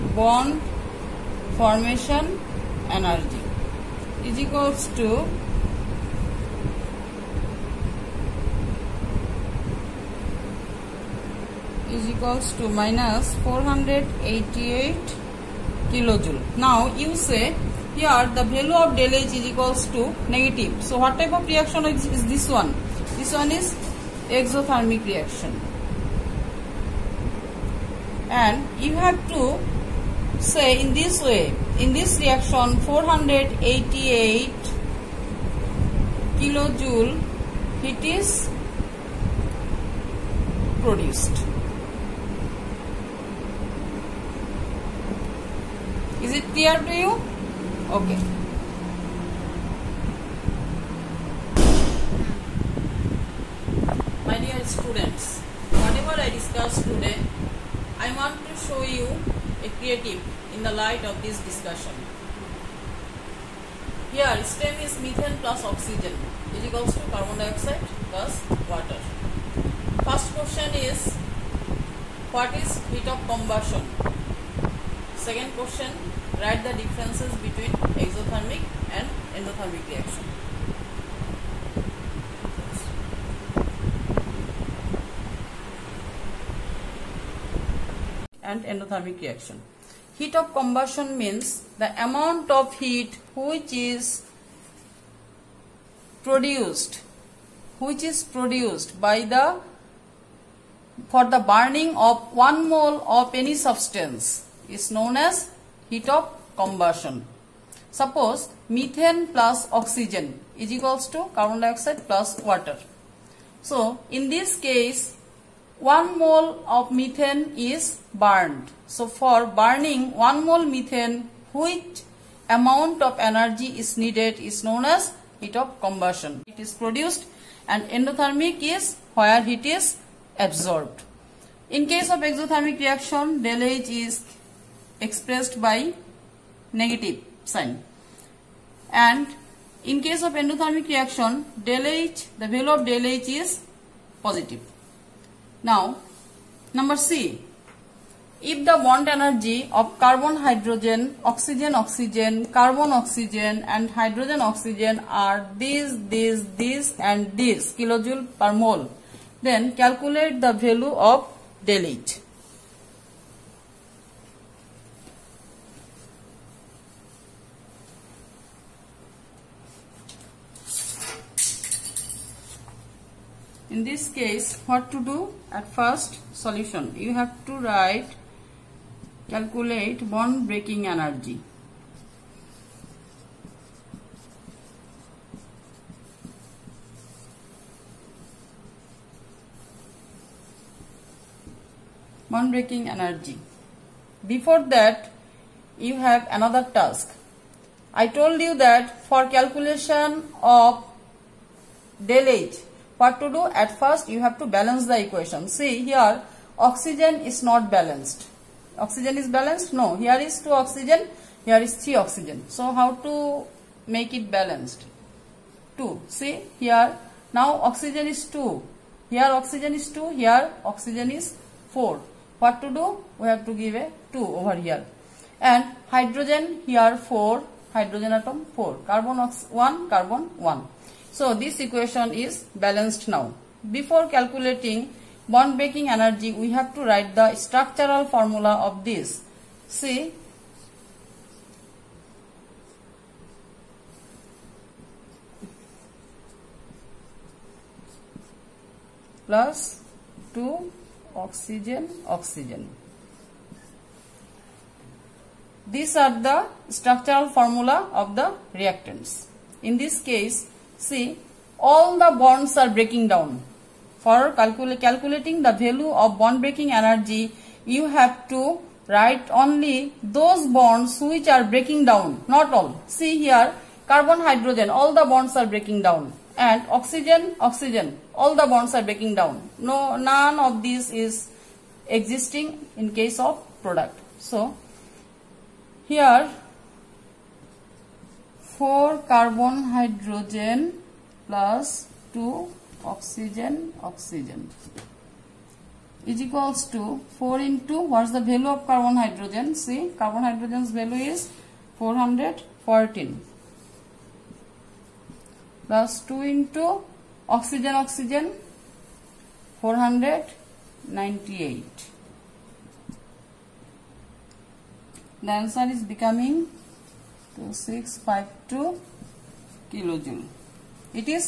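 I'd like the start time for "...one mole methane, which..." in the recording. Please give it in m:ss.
2:00.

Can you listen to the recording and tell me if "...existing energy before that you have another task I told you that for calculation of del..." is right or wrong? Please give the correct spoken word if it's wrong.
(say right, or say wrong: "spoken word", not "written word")
wrong: "breaking", not "existing".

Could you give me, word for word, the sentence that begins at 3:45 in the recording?
And hydrogen here 4, hydrogen atom 4, carbon ox 1, carbon 1.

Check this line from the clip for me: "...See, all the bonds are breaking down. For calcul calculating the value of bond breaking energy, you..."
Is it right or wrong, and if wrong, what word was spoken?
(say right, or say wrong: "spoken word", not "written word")
right.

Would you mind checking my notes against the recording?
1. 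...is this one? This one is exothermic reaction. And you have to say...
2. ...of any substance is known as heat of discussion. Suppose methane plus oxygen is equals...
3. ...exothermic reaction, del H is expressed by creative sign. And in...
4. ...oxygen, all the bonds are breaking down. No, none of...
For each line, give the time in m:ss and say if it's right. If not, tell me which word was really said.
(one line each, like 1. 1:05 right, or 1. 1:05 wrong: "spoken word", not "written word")
1. 0:22 right
2. 1:43 wrong: "combustion", not "discussion"
3. 2:12 wrong: "negative", not "creative"
4. 4:37 right.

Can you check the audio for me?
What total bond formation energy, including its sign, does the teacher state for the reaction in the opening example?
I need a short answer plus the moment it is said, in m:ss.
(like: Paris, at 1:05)
-488 kJ, at 0:12.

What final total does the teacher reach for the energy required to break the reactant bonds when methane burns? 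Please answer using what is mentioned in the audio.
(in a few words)
4652 kJ.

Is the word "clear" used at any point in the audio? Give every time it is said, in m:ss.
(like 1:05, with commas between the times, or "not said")
0:46.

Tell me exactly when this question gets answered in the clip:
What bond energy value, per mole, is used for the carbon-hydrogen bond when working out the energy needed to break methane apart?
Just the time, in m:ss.
5:01.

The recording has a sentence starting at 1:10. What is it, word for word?
First question is, what is heat of combustion?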